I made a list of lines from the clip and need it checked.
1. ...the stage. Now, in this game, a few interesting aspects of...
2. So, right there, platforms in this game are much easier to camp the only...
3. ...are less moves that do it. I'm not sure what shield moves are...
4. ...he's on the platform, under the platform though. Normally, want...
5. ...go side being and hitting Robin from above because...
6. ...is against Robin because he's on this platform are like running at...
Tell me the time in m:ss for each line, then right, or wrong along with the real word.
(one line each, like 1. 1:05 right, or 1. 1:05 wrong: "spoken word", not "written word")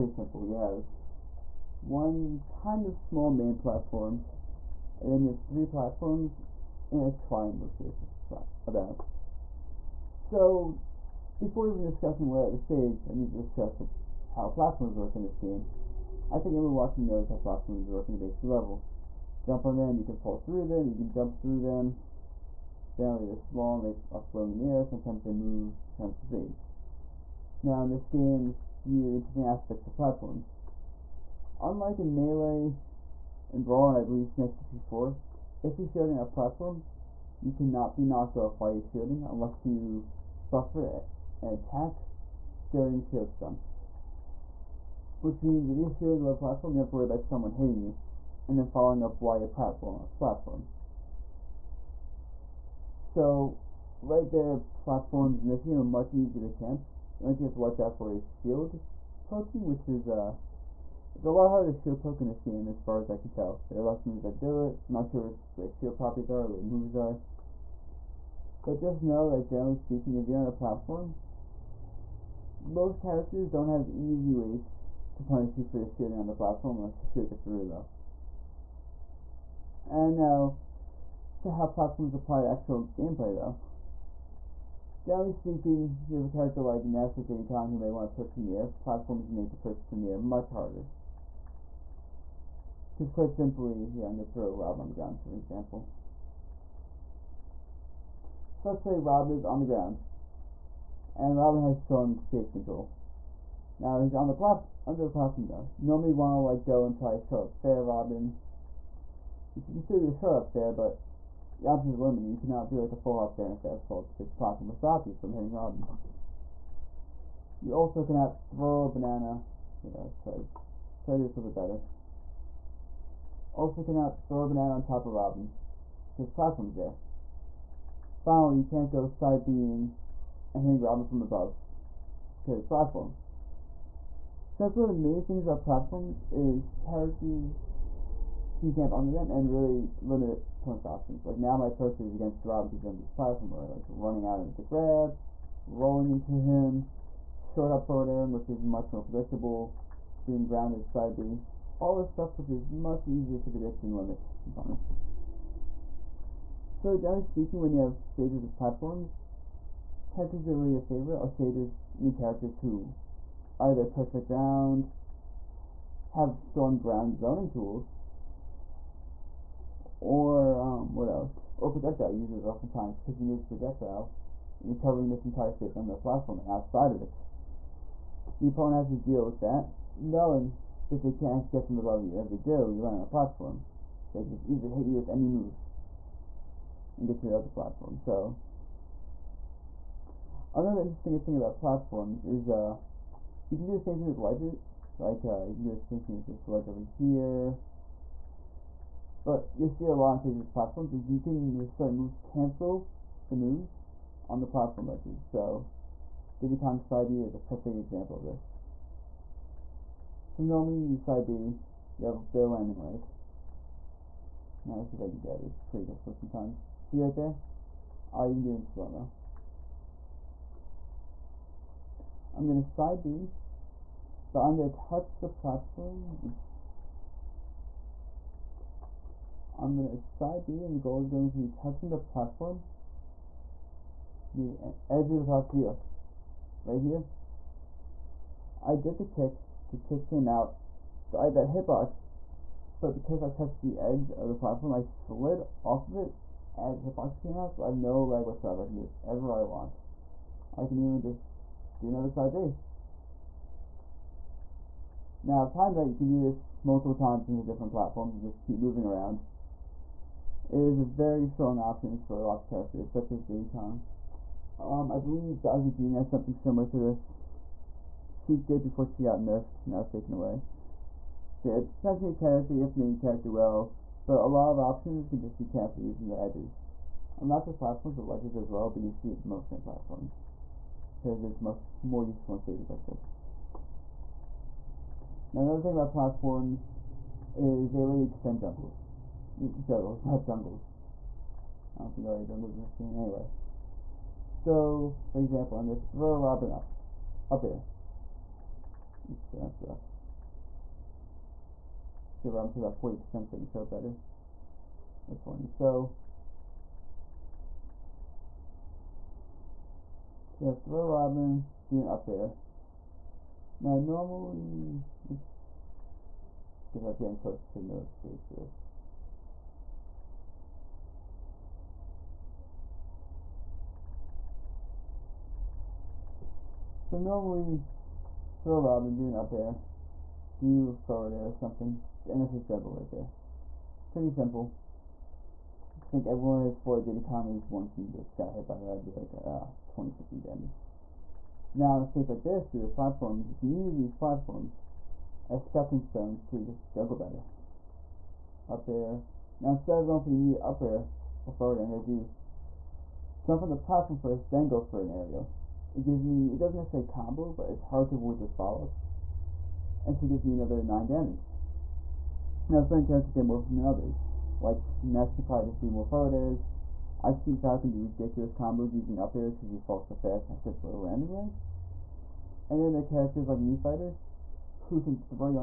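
1. 0:26 right
2. 0:52 right
3. 1:03 wrong: "properties", not "moves"
4. 1:43 right
5. 2:08 right
6. 2:21 right.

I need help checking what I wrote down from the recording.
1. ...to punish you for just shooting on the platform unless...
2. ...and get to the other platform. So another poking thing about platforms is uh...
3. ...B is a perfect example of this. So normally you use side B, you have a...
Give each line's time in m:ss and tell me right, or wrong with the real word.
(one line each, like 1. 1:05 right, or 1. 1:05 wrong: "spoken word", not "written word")
1. 1:15 right
2. 3:06 wrong: "interesting", not "poking"
3. 3:27 right.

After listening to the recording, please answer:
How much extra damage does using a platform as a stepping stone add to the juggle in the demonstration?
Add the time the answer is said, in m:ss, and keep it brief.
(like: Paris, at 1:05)
9, at 6:00.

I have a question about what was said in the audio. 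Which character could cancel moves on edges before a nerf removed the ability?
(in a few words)
Sheik.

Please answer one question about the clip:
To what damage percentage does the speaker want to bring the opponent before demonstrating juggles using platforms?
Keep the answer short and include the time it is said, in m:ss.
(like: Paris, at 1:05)
40%, at 5:02.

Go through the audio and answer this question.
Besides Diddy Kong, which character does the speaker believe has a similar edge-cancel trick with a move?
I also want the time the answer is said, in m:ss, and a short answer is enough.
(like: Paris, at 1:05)
Bowser Jr., at 4:25.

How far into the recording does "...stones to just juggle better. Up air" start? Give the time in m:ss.
5:45.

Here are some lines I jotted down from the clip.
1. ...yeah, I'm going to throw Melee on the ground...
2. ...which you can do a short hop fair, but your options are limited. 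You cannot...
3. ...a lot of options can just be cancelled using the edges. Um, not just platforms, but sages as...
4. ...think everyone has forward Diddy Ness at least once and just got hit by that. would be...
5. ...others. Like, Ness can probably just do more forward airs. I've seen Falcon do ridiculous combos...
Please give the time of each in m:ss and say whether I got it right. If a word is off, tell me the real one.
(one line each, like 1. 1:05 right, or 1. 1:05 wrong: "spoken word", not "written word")
1. 1:33 wrong: "Rob", not "Melee"
2. 1:49 right
3. 4:34 wrong: "ledges", not "sages"
4. 5:35 wrong: "Kong", not "Ness"
5. 6:03 right.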